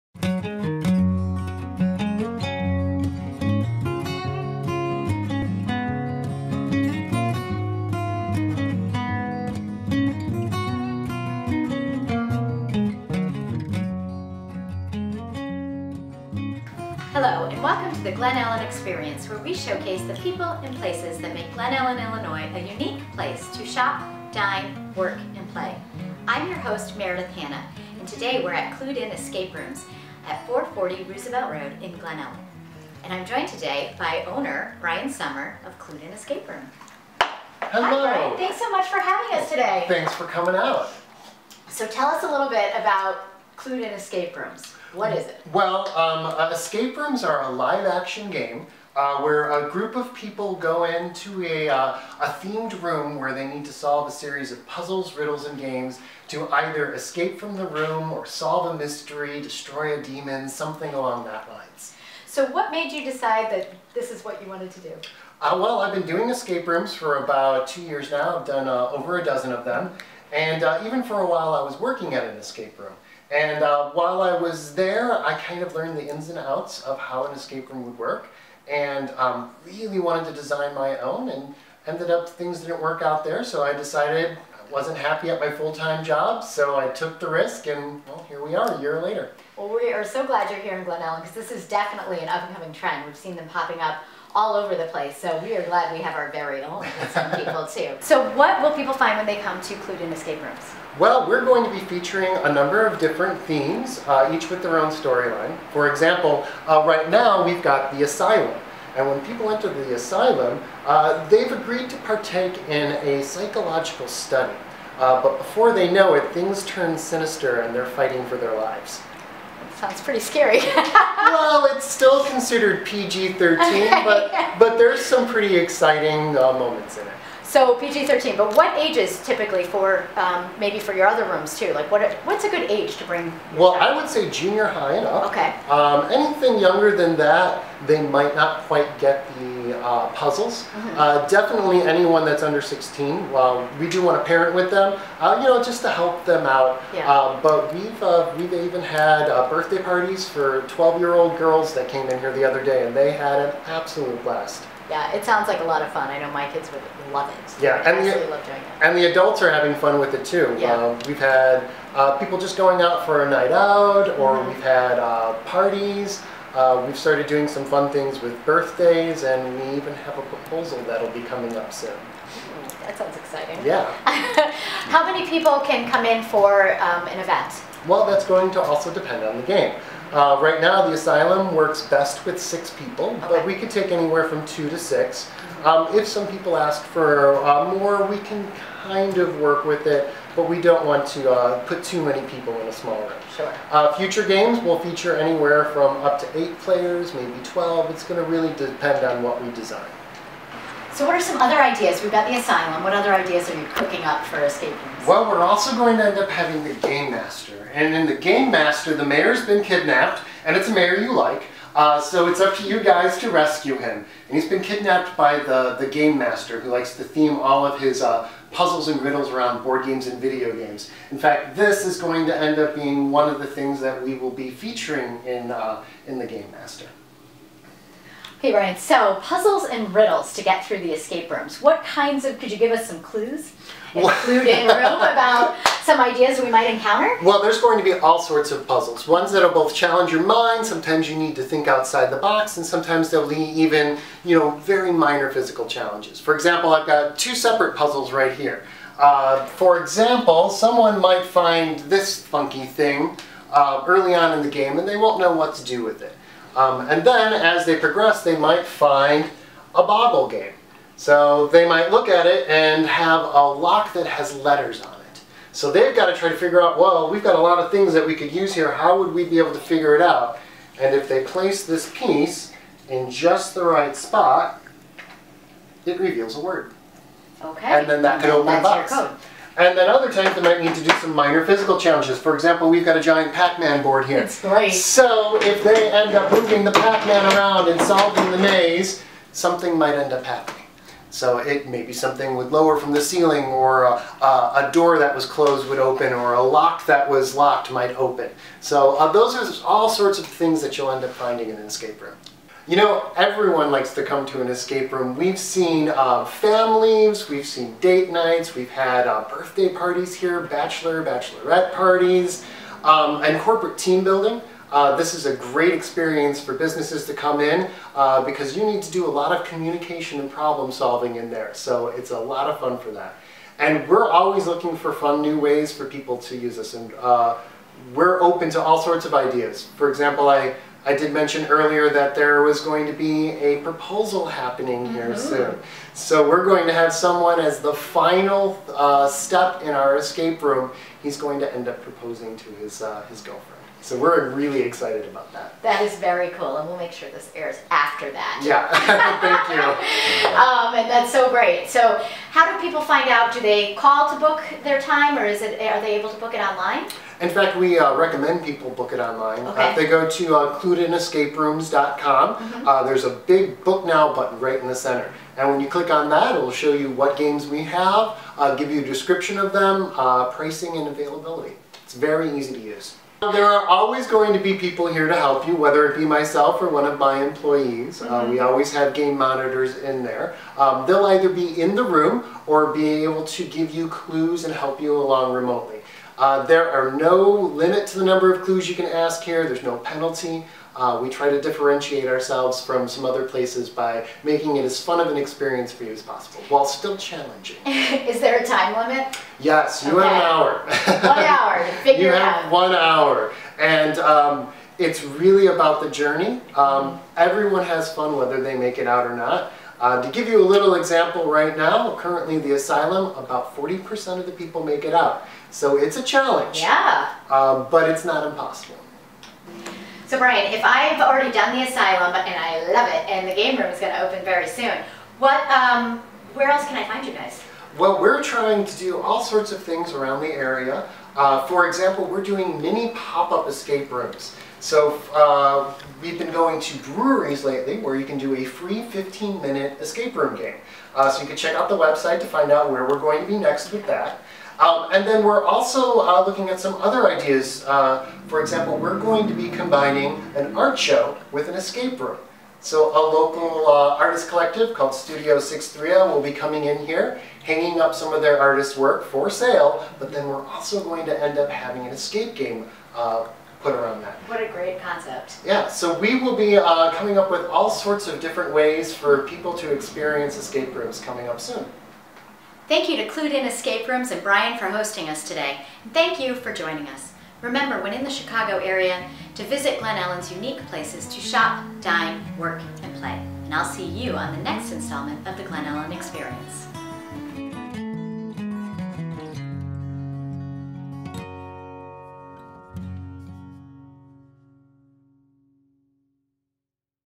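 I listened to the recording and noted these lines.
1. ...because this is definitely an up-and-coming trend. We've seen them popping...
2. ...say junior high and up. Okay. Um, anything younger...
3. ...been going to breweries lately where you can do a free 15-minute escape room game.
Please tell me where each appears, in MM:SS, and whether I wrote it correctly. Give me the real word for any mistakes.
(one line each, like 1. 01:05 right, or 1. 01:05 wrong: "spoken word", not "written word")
1. 01:31 right
2. 02:14 right
3. 07:16 right.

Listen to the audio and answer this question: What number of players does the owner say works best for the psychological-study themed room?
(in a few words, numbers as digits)
6.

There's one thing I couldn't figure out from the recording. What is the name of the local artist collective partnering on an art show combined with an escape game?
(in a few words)
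Studio 630.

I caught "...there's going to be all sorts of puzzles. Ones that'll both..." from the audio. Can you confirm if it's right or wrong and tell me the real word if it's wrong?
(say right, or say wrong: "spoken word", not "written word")
right.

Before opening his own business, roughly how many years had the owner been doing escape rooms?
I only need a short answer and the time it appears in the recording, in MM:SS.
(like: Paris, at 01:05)
2, at 01:07.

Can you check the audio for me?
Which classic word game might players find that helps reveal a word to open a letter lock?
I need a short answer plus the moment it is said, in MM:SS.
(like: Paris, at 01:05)
Boggle, at 04:19.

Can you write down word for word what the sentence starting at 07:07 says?
Well, we're trying to do all sorts of things around the area.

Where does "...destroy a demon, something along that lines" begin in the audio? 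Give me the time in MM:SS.
00:59.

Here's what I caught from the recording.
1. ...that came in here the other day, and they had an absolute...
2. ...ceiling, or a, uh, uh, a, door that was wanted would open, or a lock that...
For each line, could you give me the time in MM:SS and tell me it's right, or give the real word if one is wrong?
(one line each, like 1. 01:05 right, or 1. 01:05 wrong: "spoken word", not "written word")
1. 02:31 right
2. 04:53 wrong: "closed", not "wanted".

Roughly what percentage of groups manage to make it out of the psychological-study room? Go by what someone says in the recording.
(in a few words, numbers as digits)
40%.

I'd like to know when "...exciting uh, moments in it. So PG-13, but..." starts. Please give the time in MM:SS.
02:05.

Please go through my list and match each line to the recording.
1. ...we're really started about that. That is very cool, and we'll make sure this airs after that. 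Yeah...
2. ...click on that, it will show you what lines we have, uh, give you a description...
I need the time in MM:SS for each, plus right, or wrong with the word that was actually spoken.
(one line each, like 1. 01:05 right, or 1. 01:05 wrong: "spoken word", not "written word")
1. 05:43 wrong: "excited", not "started"
2. 06:05 wrong: "games", not "lines".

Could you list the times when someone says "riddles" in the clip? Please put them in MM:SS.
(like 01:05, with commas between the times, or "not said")
00:55, 03:39, 03:49.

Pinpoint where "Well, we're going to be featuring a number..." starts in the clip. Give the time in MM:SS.
01:40.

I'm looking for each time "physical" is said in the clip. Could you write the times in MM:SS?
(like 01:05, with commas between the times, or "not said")
04:05, 04:41.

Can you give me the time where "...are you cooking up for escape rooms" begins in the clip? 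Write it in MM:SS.
03:23.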